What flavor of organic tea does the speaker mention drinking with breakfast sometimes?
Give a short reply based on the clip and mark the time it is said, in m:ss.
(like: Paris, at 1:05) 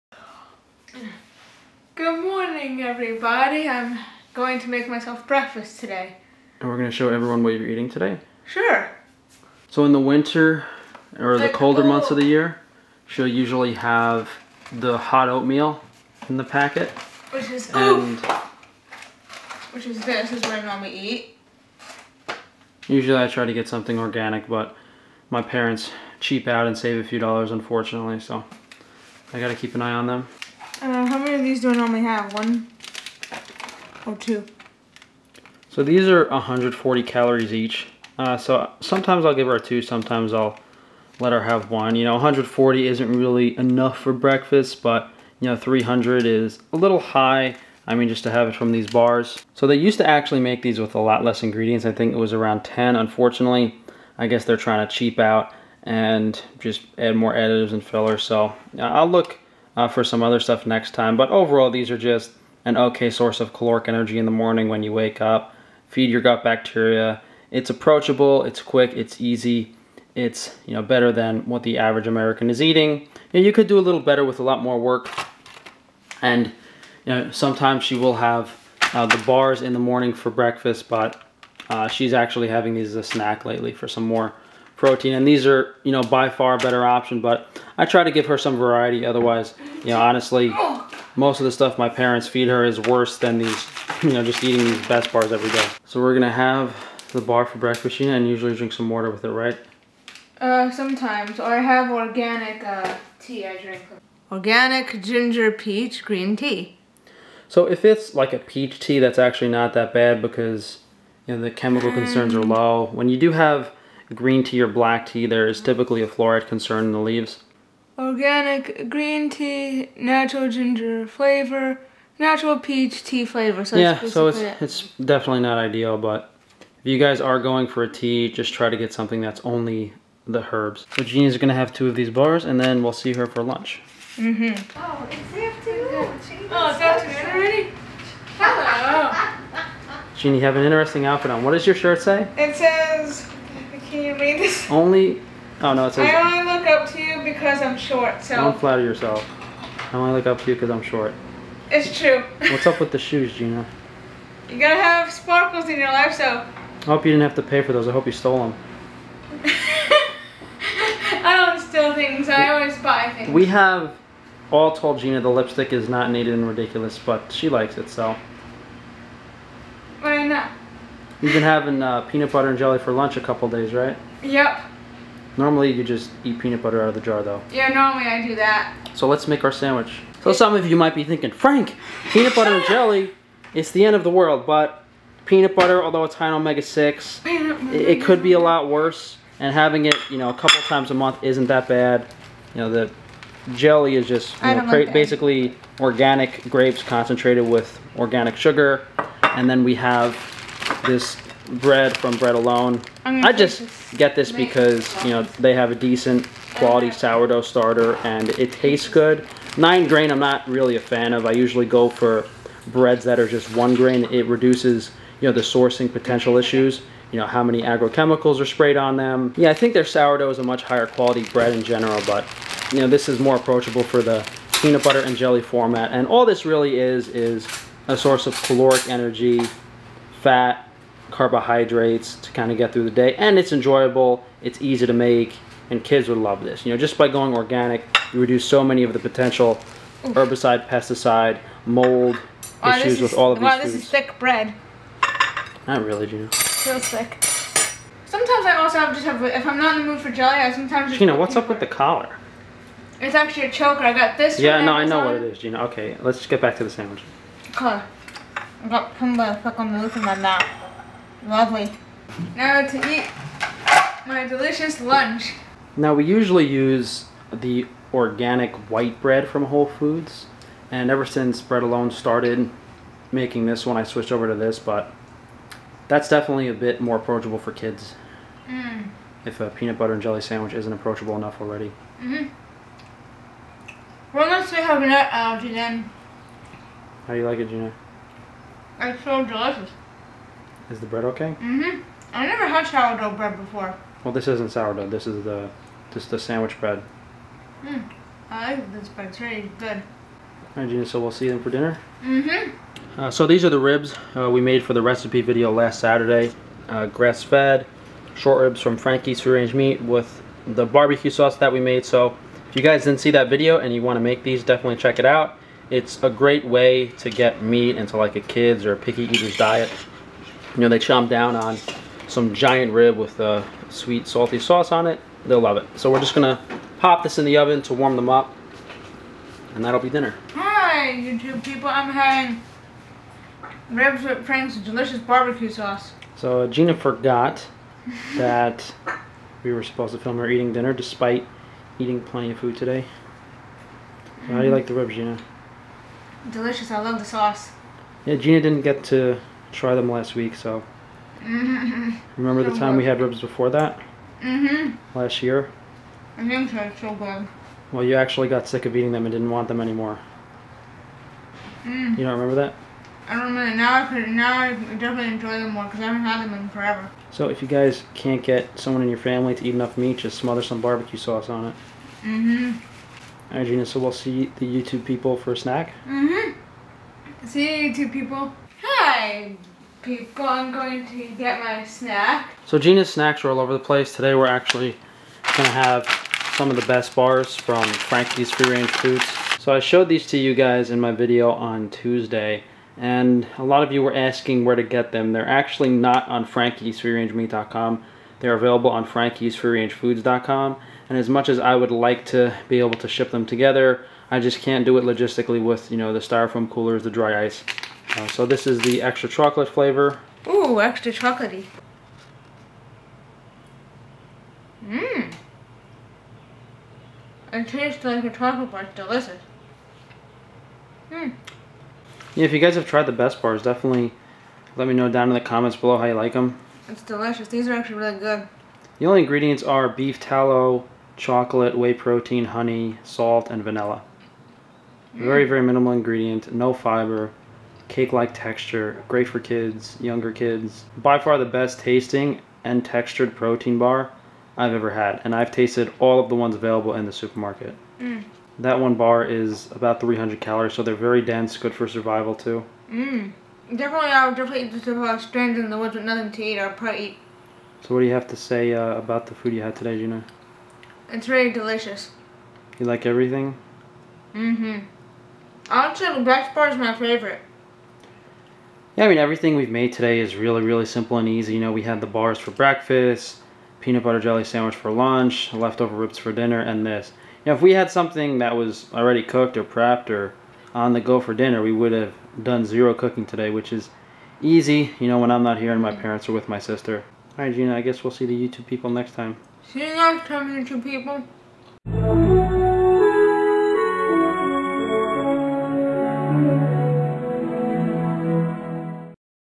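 Ginger peach green tea, at 1:44.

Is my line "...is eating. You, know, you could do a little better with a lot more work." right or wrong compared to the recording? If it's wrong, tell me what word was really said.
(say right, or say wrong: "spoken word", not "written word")
right.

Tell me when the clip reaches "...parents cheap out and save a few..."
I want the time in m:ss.
0:25.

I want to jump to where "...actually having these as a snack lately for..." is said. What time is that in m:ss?
1:22.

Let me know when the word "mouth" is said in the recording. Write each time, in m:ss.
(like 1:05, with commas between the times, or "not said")
4:20.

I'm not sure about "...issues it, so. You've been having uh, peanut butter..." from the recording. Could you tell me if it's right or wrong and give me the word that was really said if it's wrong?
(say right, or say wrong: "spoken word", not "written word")
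wrong: "likes", not "issues".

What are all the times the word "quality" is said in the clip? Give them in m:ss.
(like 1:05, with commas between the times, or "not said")
3:26, 3:40.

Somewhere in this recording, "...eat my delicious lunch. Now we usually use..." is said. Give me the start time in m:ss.
4:22.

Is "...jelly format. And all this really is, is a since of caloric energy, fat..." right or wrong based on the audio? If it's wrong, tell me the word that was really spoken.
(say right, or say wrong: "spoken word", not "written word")
wrong: "source", not "since".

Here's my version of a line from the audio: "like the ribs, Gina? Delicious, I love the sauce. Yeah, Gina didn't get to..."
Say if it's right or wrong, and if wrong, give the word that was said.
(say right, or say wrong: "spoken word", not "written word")
right.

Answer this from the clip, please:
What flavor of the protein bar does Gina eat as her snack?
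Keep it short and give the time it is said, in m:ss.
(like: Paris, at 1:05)
Extra chocolate, at 6:48.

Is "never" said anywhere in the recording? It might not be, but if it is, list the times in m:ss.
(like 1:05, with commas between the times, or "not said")
4:52.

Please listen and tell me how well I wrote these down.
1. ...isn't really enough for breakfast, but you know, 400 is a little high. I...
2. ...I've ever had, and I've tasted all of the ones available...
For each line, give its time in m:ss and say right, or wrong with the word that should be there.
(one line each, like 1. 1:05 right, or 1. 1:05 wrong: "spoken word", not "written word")
1. 0:42 wrong: "300", not "400"
2. 7:24 right.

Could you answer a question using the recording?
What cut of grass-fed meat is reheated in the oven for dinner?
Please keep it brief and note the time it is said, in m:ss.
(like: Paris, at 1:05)
Short ribs, at 5:08.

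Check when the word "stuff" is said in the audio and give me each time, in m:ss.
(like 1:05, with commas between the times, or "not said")
1:00, 1:31.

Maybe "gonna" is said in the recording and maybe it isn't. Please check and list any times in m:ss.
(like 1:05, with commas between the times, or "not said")
1:36, 2:11, 5:26.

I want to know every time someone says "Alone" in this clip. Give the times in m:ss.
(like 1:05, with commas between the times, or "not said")
3:22, 4:31.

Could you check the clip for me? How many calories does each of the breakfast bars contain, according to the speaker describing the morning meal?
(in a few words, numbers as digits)
140.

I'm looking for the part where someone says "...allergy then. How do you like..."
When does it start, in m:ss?
4:45.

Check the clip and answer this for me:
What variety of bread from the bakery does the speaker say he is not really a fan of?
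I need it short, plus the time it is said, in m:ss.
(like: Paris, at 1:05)
Nine grain, at 3:29.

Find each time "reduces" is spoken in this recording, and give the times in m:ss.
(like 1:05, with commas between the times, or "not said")
3:34, 3:58.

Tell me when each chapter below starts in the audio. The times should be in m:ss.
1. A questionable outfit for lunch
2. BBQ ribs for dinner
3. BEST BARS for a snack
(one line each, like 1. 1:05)
1. 2:14
2. 5:02
3. 6:18.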